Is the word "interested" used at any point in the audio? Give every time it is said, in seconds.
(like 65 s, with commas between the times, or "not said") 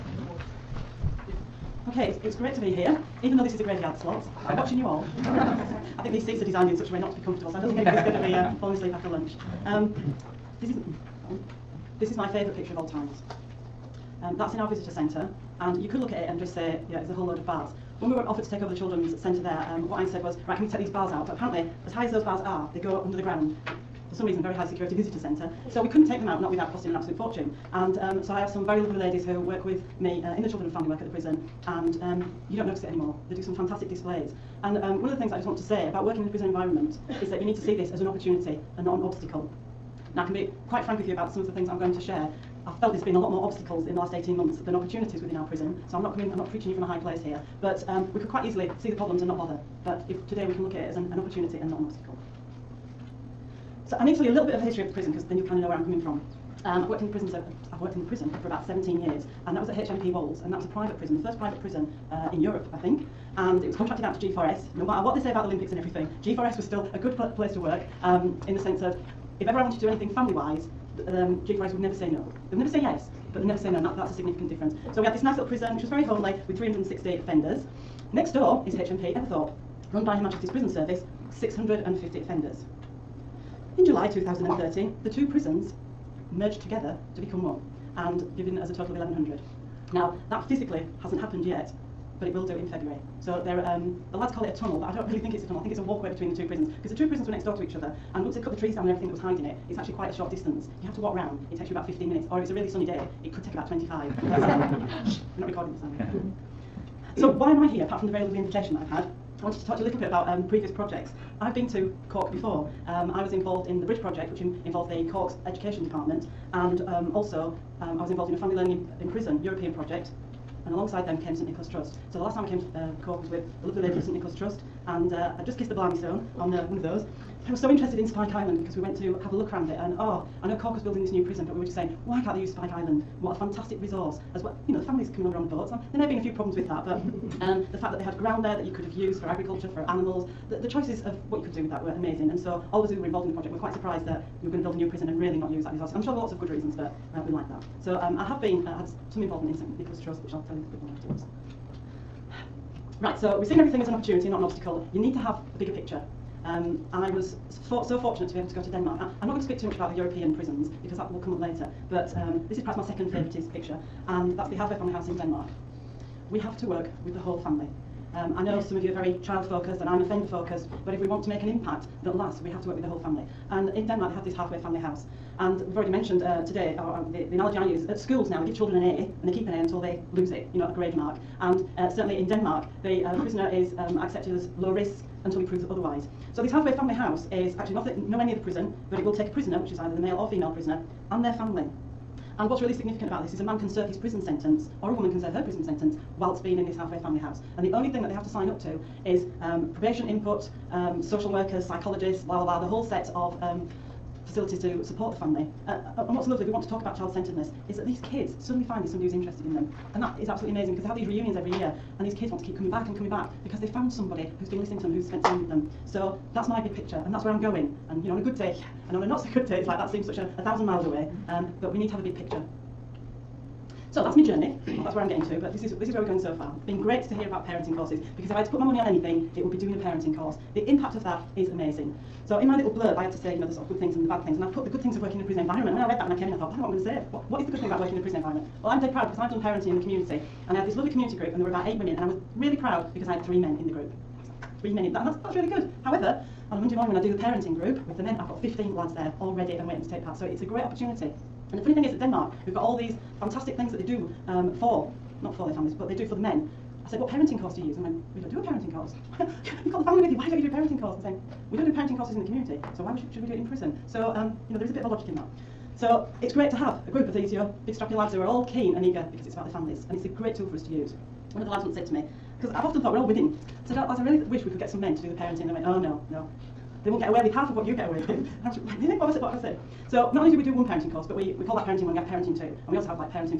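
127 s, 209 s.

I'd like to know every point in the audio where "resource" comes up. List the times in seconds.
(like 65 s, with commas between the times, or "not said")
133 s, 145 s.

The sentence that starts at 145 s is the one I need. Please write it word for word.
I'm sure there were lots of good reasons, but uh, we like that.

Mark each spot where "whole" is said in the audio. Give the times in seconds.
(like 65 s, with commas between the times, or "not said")
17 s, 167 s, 172 s, 202 s.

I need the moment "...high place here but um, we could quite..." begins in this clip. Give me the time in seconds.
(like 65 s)
46 s.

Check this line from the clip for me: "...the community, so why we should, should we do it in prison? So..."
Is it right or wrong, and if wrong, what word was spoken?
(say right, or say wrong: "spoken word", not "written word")
right.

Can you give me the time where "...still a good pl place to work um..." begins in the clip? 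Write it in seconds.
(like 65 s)
66 s.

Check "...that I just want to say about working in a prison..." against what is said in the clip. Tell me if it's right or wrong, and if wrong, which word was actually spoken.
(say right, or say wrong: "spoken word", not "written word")
right.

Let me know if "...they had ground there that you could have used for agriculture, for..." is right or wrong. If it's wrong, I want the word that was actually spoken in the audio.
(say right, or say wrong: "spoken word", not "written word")
right.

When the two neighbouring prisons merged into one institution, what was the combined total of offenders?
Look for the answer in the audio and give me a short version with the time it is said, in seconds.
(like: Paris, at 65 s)
1100, at 88 s.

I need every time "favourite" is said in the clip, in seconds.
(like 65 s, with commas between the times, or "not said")
12 s, 163 s.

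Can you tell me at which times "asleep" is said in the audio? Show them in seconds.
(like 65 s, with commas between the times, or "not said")
8 s.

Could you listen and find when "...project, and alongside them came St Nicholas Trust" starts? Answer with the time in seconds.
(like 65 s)
119 s.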